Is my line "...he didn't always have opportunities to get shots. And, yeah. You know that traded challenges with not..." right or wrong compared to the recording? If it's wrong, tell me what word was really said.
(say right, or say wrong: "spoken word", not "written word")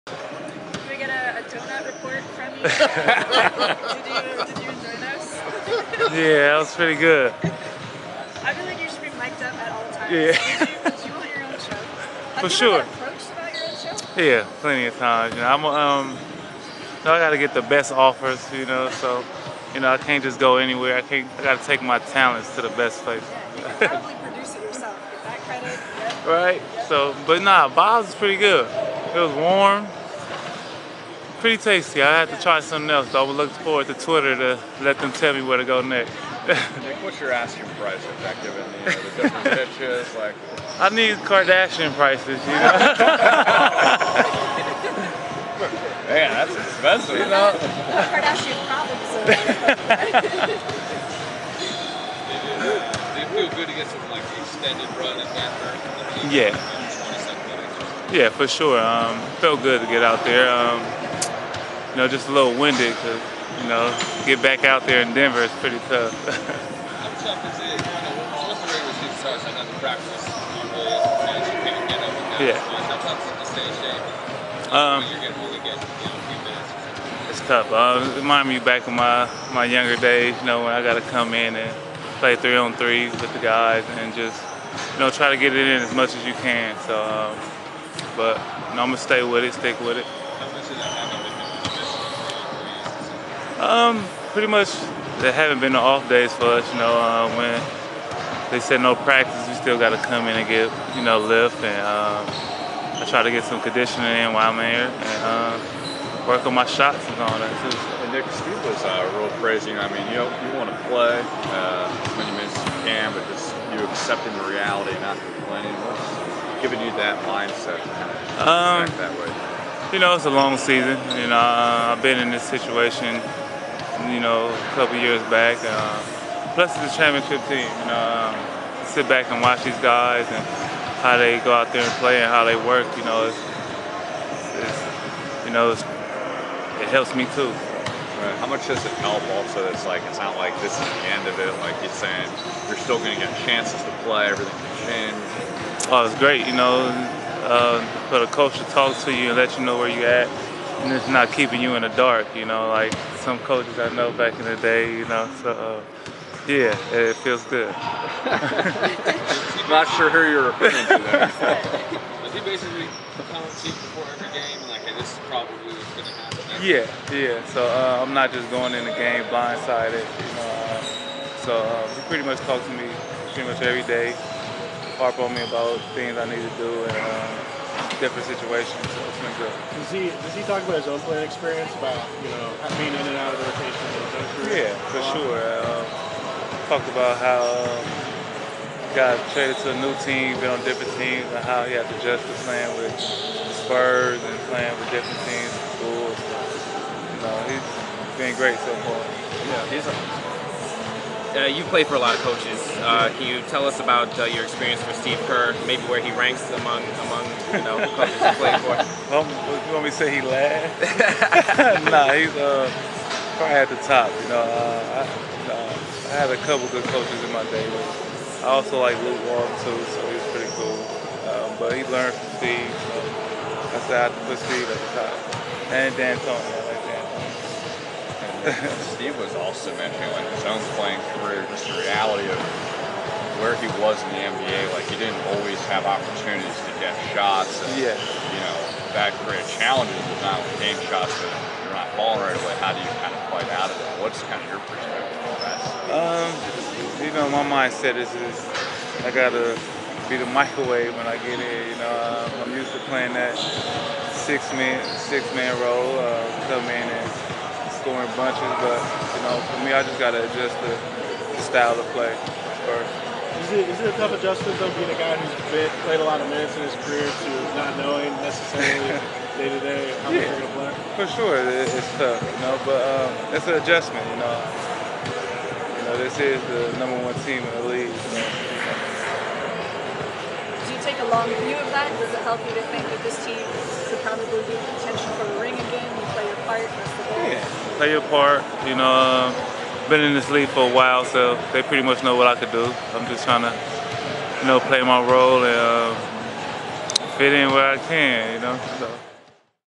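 wrong: "created", not "traded".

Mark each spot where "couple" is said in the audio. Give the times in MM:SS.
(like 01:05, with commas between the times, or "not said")
02:04, 03:36.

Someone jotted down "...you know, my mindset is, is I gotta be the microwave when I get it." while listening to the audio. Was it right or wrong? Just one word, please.
right.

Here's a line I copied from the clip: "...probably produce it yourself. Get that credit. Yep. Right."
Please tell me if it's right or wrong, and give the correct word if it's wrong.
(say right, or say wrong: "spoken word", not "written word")
right.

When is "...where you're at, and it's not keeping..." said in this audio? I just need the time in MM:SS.
02:29.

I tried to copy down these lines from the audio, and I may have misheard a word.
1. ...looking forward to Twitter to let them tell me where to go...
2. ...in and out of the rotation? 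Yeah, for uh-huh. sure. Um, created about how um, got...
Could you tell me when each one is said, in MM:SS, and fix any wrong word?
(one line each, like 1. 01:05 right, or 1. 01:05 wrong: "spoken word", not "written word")
1. 00:33 right
2. 03:02 wrong: "talked", not "created".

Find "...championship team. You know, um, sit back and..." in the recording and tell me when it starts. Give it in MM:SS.
02:06.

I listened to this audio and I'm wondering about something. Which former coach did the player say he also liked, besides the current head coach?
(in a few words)
Luke Walton.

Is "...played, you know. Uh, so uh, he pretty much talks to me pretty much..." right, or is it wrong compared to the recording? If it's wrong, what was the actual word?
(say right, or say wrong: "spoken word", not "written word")
wrong: "blindsided", not "played".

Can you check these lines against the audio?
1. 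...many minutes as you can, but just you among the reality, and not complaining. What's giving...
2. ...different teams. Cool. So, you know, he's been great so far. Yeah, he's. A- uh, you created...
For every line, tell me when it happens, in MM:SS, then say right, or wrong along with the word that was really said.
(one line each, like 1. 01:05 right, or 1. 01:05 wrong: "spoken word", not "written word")
1. 01:52 wrong: "accepting", not "among"
2. 03:14 wrong: "played", not "created".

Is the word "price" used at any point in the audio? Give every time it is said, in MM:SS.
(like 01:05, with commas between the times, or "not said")
00:37, 00:41.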